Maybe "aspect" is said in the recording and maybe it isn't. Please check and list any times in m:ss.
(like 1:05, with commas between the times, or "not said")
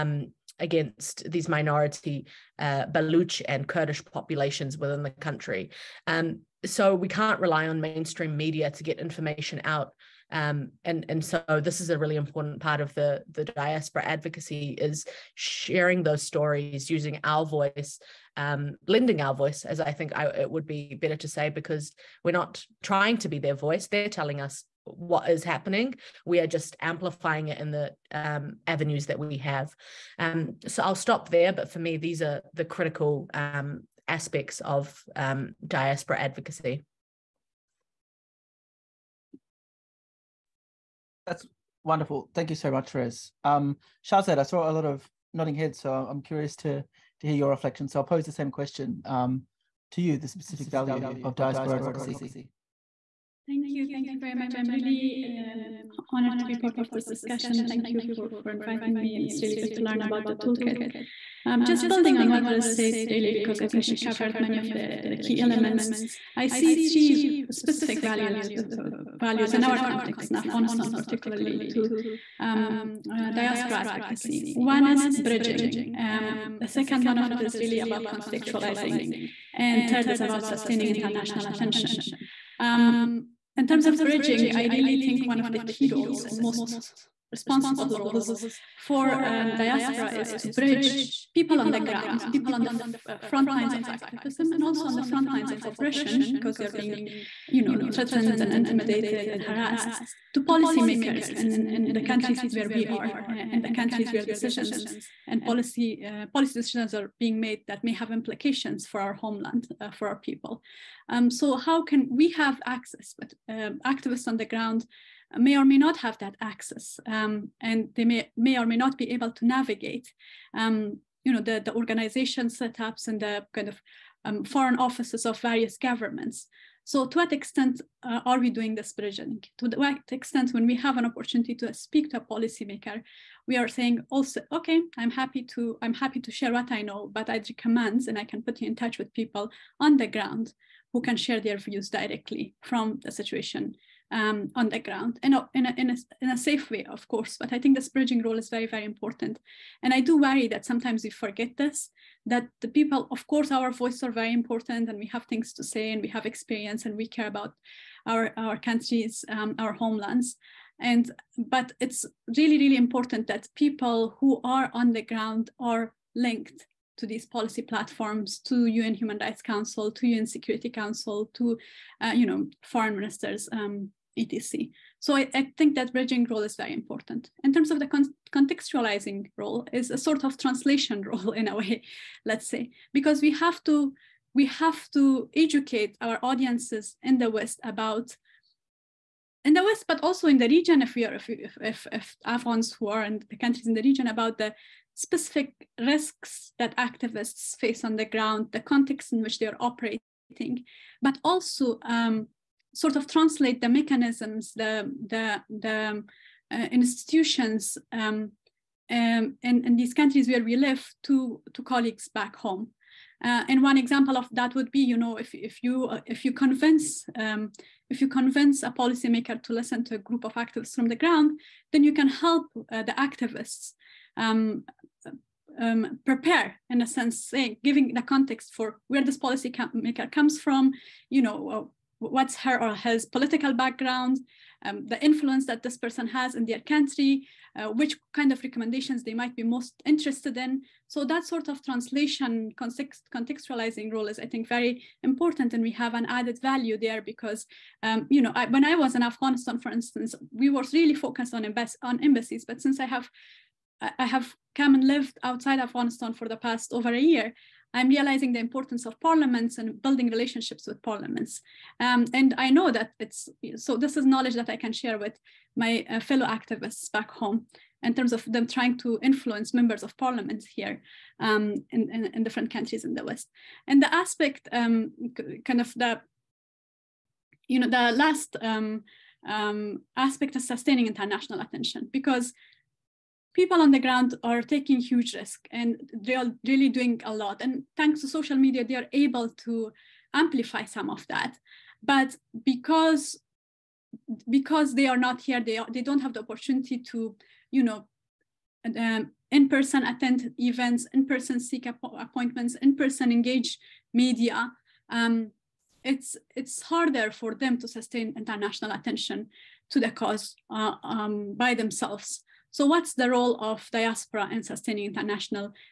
0:34, 4:33, 4:39.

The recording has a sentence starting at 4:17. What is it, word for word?
I'm realizing the importance of parliaments and building relationships with parliaments.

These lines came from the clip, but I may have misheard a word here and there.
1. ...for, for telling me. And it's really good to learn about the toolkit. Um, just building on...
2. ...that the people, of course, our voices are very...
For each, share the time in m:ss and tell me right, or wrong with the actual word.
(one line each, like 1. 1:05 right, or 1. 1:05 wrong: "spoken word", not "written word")
1. 0:58 wrong: "inviting", not "telling"
2. 2:32 right.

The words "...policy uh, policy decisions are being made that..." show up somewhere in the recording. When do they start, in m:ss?
1:45.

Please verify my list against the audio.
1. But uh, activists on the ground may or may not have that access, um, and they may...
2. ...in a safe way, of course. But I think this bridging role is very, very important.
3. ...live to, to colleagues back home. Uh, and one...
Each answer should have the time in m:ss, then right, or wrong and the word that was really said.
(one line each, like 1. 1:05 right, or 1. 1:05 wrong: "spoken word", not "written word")
1. 1:53 right
2. 2:26 right
3. 3:30 right.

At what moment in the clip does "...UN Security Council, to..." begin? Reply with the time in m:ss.
2:50.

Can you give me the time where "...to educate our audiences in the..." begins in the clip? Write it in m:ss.
3:04.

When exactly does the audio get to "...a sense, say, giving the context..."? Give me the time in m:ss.
3:46.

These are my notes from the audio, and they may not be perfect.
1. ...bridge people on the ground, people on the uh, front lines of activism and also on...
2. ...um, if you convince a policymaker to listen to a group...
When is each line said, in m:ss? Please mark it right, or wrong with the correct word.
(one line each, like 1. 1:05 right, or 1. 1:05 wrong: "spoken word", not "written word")
1. 1:30 right
2. 3:37 right.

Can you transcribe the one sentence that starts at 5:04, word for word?
Um, it's it's harder for them to sustain international attention to the cause uh, um, by themselves.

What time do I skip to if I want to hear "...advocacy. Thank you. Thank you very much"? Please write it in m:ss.
0:51.